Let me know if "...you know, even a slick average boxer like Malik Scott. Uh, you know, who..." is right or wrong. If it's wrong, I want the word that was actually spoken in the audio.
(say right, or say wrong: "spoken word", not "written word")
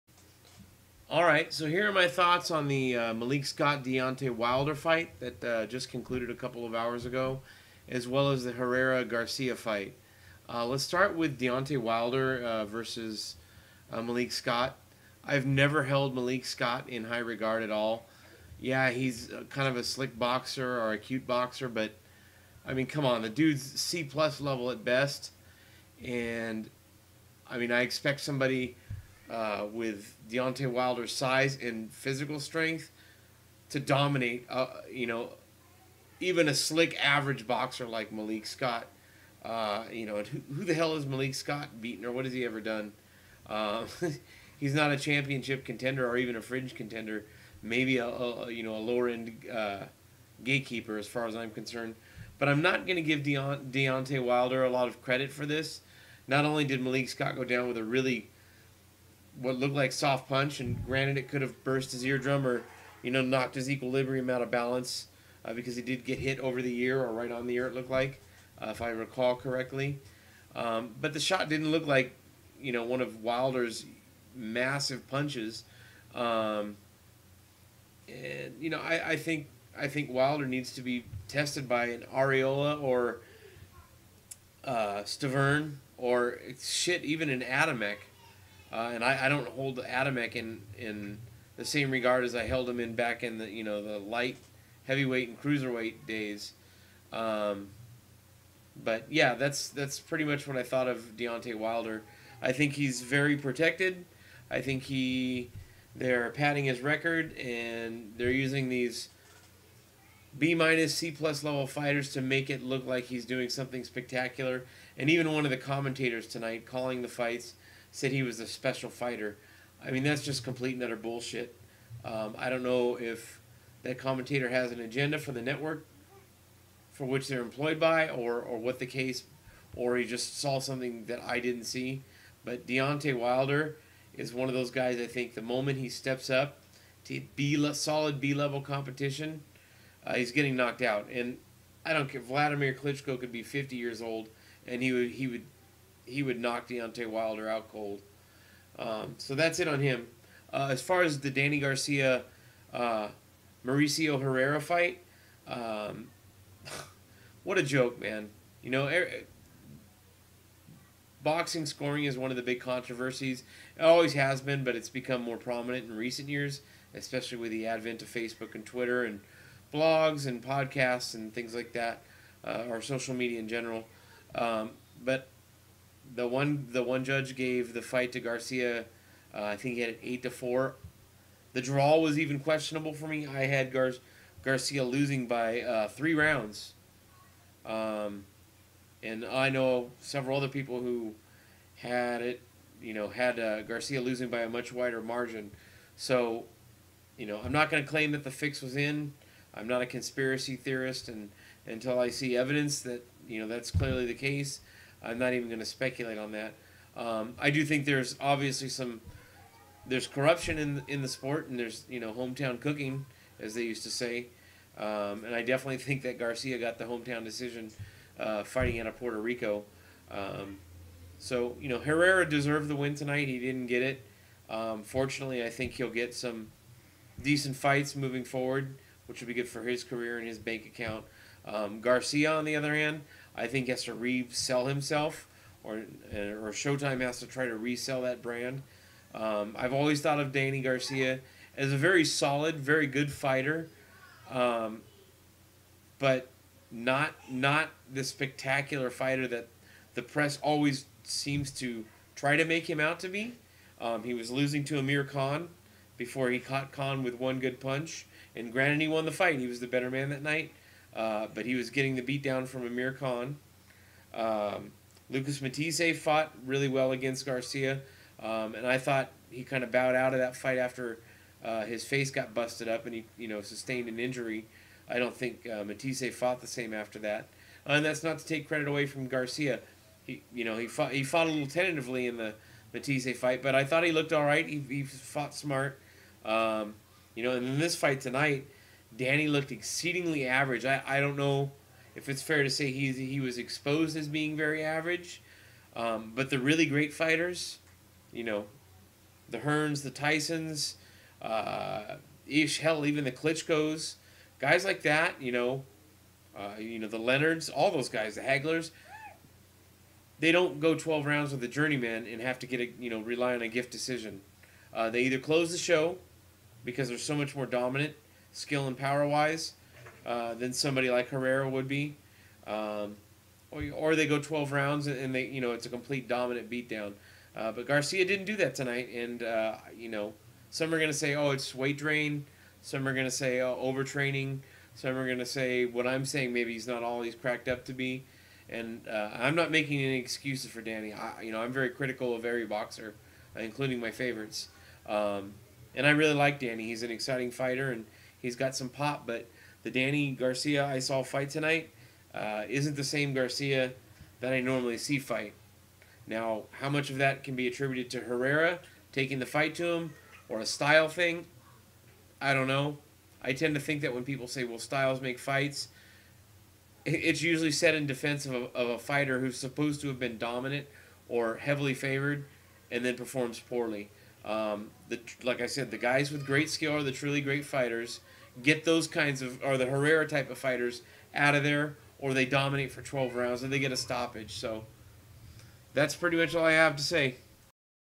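right.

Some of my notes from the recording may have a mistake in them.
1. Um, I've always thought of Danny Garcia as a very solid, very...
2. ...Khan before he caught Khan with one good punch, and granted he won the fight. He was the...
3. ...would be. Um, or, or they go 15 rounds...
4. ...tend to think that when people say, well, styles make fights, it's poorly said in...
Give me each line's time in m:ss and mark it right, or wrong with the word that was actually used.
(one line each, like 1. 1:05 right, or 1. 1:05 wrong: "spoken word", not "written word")
1. 3:59 right
2. 4:15 right
3. 5:21 wrong: "12", not "15"
4. 6:03 wrong: "usually", not "poorly".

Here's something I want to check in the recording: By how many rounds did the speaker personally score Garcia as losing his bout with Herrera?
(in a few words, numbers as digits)
3.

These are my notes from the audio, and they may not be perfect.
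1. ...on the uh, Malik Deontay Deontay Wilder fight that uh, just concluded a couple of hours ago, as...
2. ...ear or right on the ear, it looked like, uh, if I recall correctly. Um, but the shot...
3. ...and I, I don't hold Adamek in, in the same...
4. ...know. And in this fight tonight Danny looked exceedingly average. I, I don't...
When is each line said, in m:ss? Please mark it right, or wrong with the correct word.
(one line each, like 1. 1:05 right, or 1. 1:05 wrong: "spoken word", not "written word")
1. 0:02 wrong: "Scott", not "Deontay"
2. 1:06 right
3. 1:28 right
4. 4:47 right.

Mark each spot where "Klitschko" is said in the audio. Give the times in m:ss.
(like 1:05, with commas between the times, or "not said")
2:22, 5:03.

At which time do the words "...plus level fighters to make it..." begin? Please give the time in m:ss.
1:51.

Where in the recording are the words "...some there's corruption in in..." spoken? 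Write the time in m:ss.
3:28.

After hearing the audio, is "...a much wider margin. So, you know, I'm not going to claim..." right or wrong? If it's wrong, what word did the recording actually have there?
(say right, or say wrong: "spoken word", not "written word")
right.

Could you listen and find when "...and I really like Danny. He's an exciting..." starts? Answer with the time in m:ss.
5:45.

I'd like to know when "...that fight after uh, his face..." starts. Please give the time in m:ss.
4:30.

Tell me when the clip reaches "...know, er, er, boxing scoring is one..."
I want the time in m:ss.
2:38.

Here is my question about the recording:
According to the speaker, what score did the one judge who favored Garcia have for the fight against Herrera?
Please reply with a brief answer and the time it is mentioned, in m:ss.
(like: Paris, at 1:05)
8 to 4, at 3:00.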